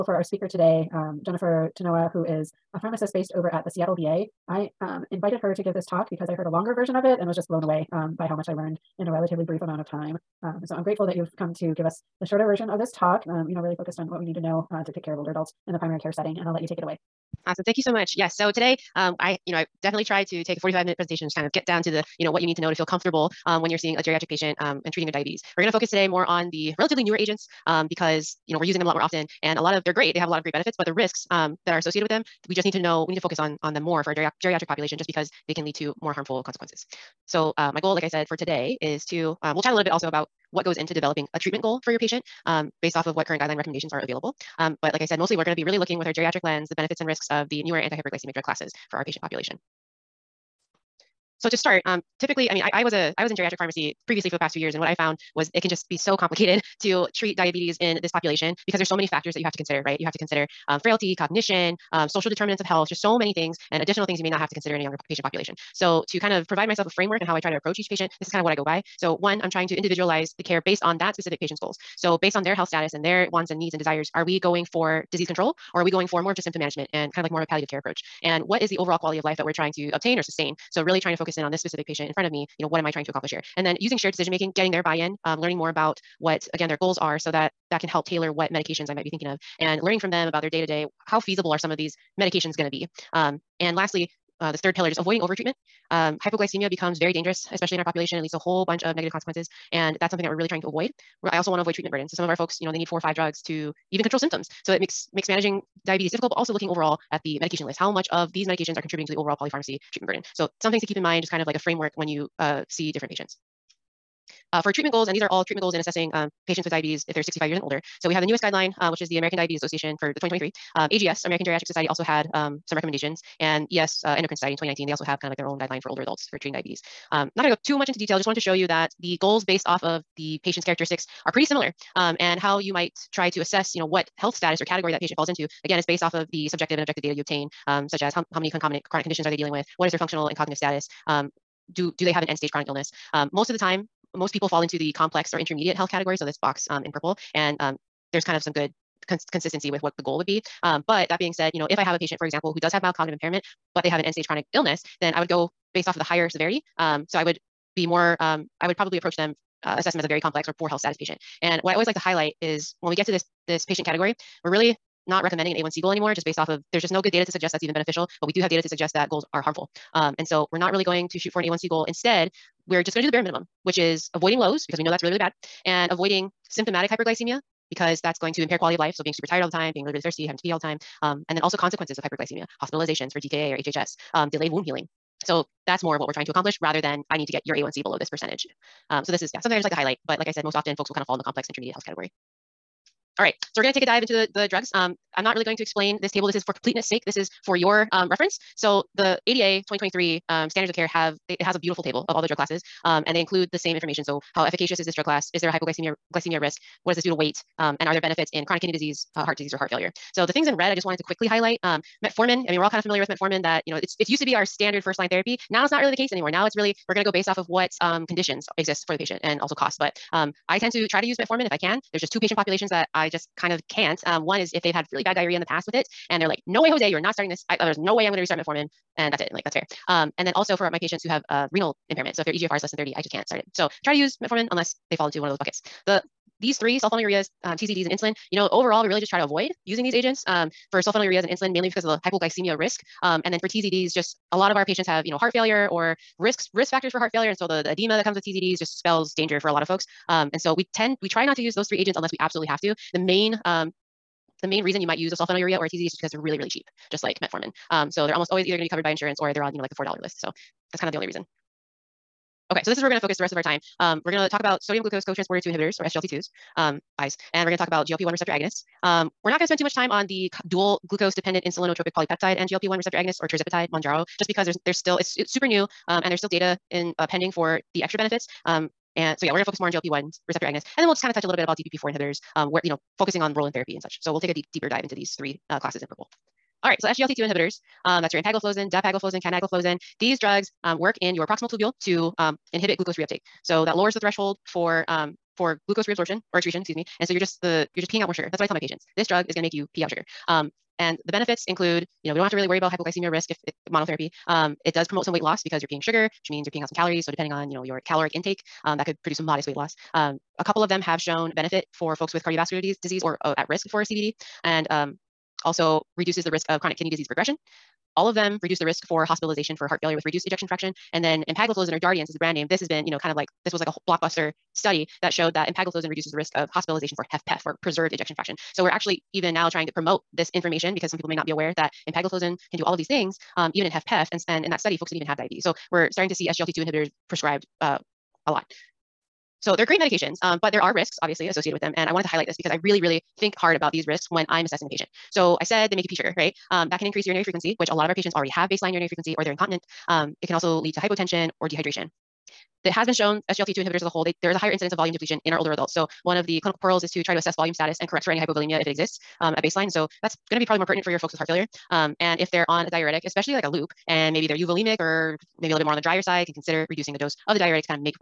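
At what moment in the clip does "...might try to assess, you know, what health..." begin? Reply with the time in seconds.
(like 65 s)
132 s.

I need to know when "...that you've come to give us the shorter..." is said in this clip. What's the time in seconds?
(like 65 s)
11 s.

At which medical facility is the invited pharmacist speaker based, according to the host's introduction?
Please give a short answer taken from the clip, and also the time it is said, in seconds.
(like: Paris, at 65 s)
Seattle VA, at 3 s.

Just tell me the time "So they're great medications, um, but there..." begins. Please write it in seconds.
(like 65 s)
339 s.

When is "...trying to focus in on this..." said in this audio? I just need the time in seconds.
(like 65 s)
80 s.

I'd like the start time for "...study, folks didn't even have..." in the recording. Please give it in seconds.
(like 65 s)
334 s.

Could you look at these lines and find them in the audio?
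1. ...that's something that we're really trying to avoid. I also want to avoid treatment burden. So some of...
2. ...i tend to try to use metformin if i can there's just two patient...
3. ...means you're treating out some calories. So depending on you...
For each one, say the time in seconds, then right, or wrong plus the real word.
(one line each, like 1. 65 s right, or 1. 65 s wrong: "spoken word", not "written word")
1. 100 s right
2. 220 s right
3. 306 s wrong: "peeing", not "treating".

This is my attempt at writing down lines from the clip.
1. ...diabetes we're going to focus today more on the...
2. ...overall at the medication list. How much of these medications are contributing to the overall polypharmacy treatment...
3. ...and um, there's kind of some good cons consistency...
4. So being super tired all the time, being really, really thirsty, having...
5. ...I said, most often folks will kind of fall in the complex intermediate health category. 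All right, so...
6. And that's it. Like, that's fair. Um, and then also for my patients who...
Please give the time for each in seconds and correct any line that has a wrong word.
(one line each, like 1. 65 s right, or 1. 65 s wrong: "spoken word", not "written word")
1. 25 s right
2. 106 s right
3. 147 s right
4. 178 s right
5. 190 s right
6. 228 s right.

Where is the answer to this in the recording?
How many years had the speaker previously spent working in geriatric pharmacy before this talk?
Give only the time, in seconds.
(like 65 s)
54 s.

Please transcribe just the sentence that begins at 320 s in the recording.
And then empagliflozin or Jardiance is the brand name.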